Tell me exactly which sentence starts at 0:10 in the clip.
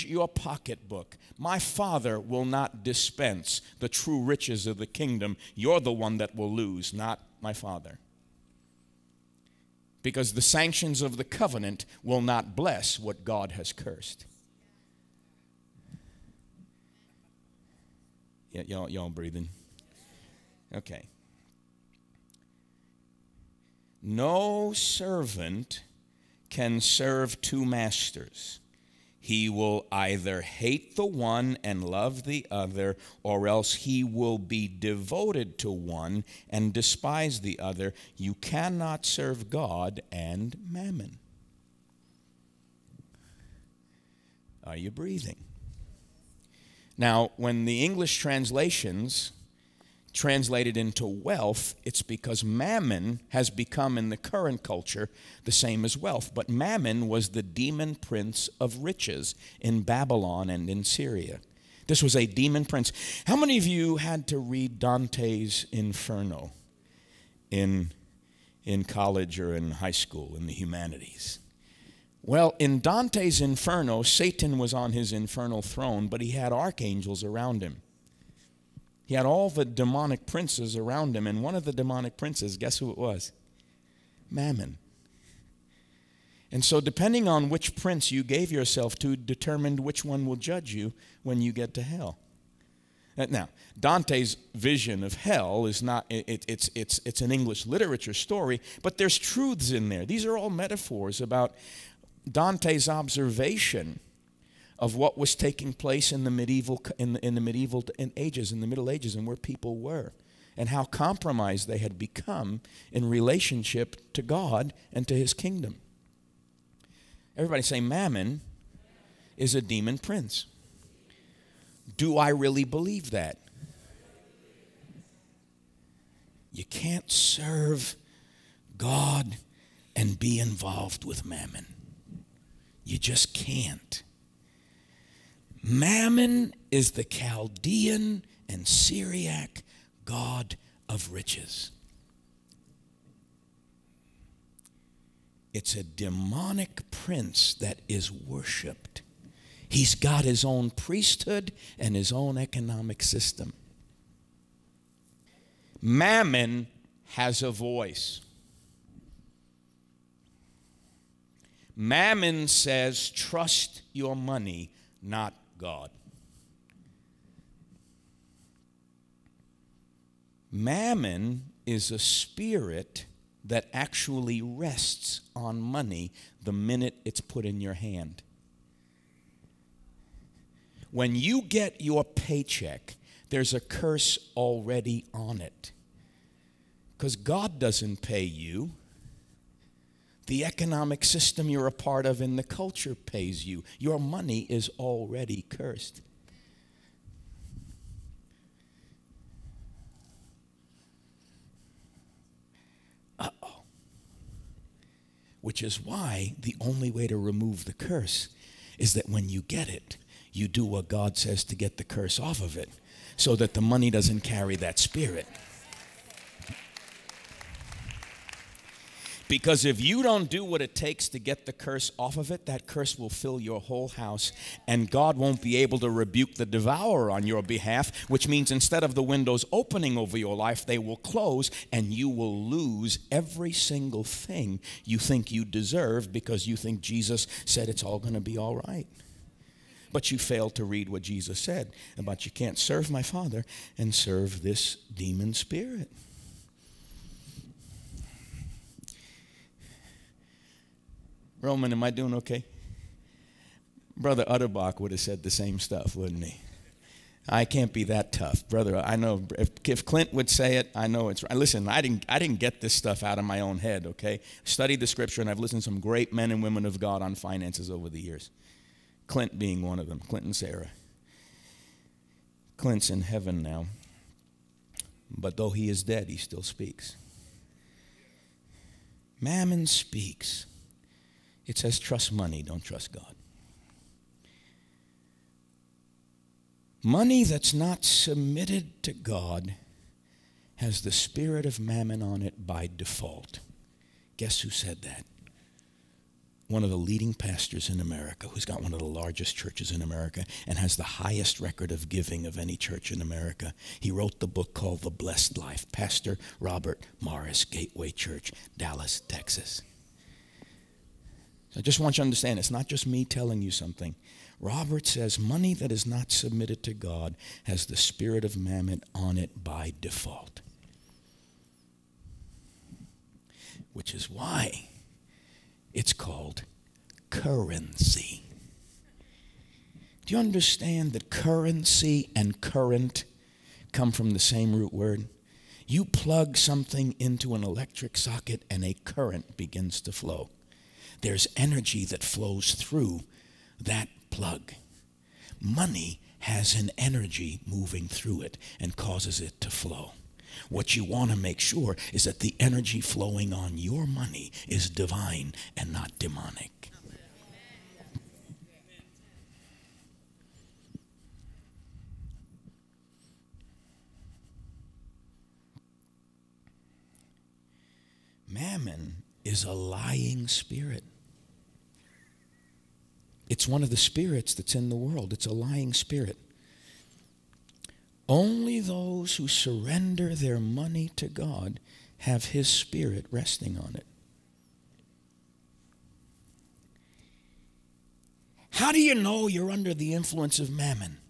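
Because the sanctions of the covenant will not bless what God has cursed.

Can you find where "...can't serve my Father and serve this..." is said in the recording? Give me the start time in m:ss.
4:02.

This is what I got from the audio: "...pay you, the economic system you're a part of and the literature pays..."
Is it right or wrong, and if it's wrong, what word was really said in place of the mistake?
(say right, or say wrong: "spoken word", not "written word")
wrong: "culture", not "literature".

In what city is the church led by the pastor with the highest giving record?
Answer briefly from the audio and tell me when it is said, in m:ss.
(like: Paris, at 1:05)
Dallas, Texas, at 5:08.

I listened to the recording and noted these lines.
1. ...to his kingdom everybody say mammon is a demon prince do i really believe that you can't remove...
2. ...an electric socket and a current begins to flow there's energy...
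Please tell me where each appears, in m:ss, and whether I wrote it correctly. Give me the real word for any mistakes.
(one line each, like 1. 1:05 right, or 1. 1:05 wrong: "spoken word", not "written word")
1. 1:55 wrong: "serve", not "remove"
2. 5:37 right.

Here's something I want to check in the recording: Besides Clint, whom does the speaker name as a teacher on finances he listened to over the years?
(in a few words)
Sarah.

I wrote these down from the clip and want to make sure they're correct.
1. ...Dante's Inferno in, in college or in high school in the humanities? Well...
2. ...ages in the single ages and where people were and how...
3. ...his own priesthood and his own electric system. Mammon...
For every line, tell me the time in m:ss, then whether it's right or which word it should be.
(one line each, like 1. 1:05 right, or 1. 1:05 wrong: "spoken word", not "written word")
1. 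1:04 right
2. 1:48 wrong: "middle", not "single"
3. 2:30 wrong: "economic", not "electric".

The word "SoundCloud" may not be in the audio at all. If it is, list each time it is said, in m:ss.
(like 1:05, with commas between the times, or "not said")
not said.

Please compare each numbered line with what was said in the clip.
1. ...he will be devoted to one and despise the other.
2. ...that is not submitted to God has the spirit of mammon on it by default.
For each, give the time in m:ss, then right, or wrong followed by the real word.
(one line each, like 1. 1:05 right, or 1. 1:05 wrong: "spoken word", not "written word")
1. 0:33 right
2. 5:15 right.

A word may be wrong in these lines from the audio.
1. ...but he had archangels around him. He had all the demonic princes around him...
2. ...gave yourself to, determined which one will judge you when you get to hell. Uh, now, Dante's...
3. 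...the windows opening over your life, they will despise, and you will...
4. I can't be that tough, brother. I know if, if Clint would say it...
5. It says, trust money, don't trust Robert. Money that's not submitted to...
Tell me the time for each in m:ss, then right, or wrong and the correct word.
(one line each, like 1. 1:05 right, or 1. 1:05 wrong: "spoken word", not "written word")
1. 1:16 right
2. 1:28 right
3. 3:48 wrong: "close", not "despise"
4. 4:17 right
5. 4:41 wrong: "God", not "Robert".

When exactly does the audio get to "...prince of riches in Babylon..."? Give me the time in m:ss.
0:57.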